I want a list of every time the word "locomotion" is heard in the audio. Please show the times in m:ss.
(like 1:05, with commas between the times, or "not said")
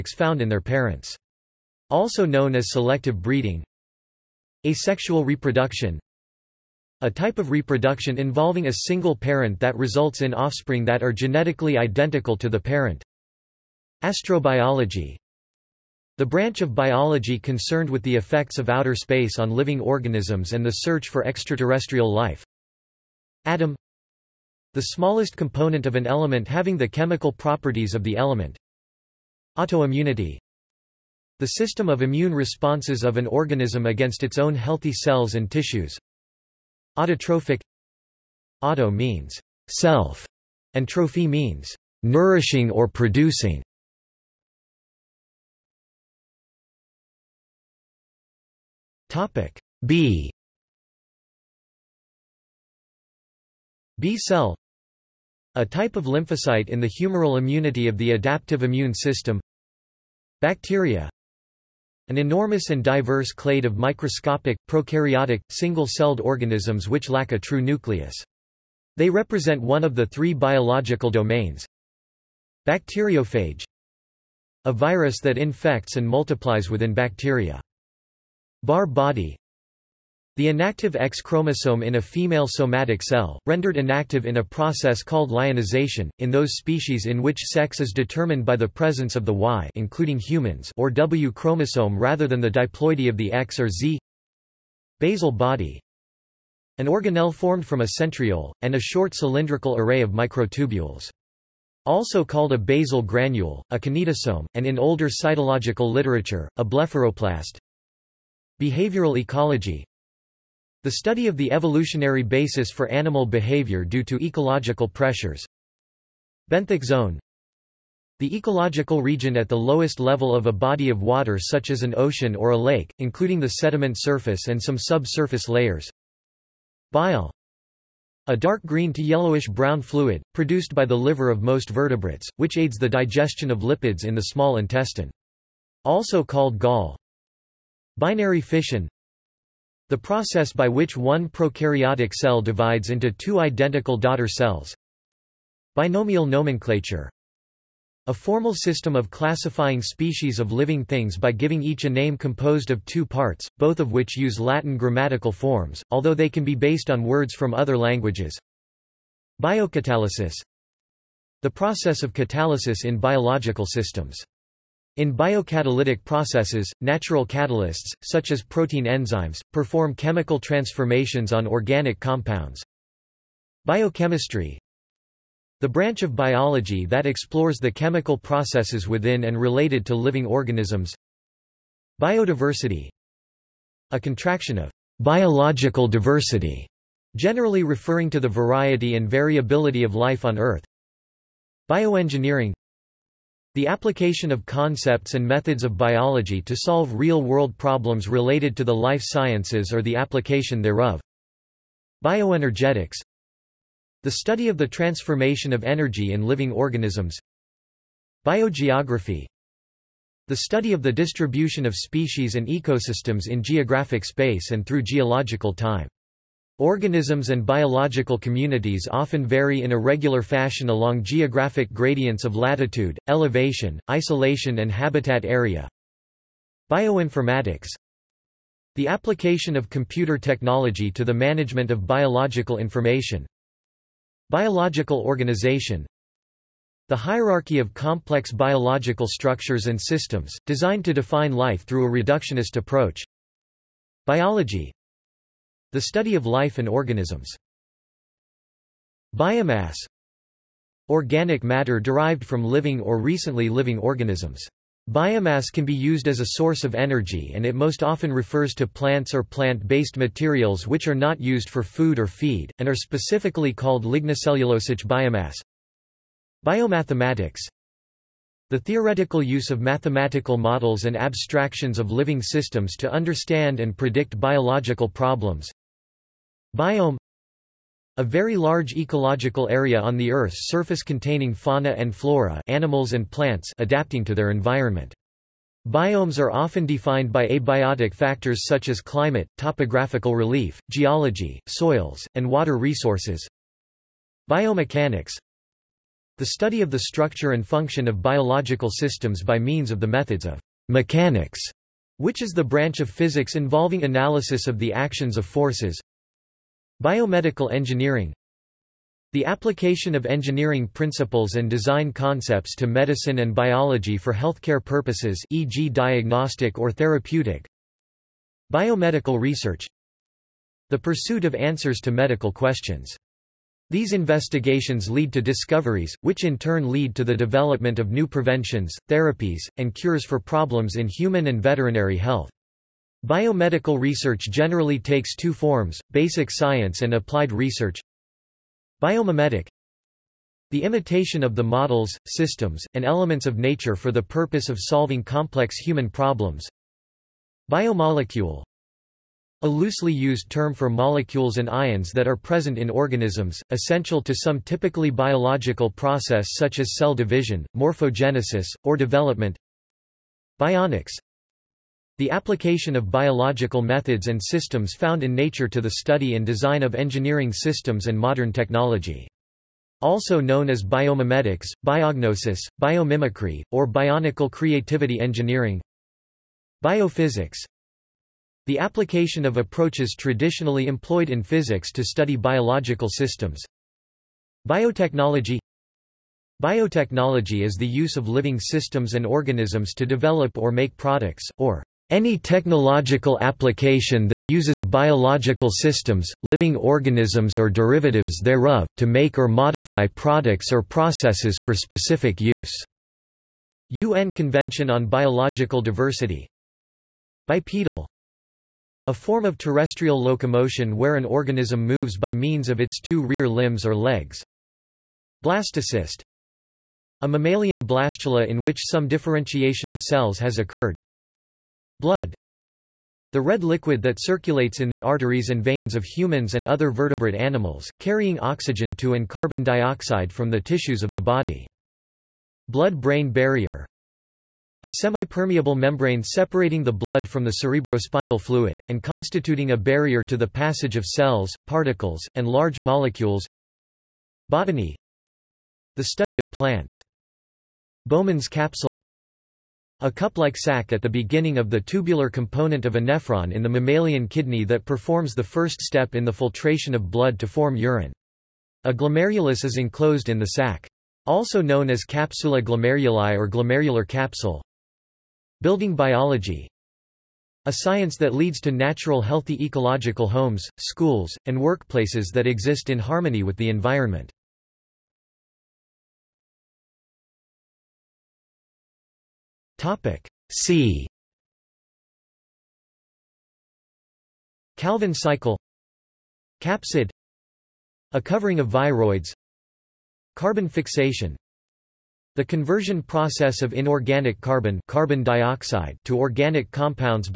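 6:50.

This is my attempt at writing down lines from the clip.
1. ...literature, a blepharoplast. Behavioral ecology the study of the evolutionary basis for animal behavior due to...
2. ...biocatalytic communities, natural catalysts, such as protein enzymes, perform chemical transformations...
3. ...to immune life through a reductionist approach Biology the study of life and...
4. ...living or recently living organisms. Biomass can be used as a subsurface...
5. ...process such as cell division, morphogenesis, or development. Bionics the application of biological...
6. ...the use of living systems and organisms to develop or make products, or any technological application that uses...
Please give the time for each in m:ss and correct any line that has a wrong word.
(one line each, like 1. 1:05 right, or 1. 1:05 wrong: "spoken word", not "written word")
1. 1:45 right
2. 2:45 wrong: "processes", not "communities"
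3. 4:00 wrong: "define", not "immune"
4. 4:12 wrong: "source", not "subsurface"
5. 5:55 right
6. 6:27 right.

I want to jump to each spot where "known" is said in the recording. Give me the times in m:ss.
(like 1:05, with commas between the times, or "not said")
0:02, 6:10, 7:41.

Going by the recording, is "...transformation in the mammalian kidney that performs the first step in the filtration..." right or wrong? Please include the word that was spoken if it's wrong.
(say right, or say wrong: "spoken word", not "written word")
wrong: "nephron", not "transformation".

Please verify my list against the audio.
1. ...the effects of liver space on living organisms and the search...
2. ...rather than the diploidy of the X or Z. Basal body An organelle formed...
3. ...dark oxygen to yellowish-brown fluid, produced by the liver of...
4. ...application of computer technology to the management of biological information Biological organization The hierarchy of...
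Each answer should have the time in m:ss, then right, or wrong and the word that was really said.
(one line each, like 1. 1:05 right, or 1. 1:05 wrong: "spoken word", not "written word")
1. 0:18 wrong: "outer", not "liver"
2. 1:31 right
3. 2:08 wrong: "green", not "oxygen"
4. 3:48 right.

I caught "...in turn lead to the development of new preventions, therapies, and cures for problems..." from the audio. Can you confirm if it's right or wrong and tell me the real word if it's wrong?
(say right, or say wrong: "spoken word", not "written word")
right.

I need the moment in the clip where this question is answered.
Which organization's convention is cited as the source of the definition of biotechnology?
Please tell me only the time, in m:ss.
6:43.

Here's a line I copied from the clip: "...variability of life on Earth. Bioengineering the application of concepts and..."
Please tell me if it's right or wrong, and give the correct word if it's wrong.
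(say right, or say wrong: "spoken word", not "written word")
right.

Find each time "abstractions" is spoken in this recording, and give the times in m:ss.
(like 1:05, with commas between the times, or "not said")
4:30.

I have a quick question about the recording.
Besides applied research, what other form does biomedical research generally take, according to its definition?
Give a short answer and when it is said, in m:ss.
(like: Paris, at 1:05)
basic science, at 5:35.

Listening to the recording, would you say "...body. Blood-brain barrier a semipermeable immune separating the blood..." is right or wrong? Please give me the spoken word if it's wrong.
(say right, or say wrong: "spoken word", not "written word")
wrong: "membrane", not "immune".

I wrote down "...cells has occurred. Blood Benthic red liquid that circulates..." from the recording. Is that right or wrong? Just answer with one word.
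wrong.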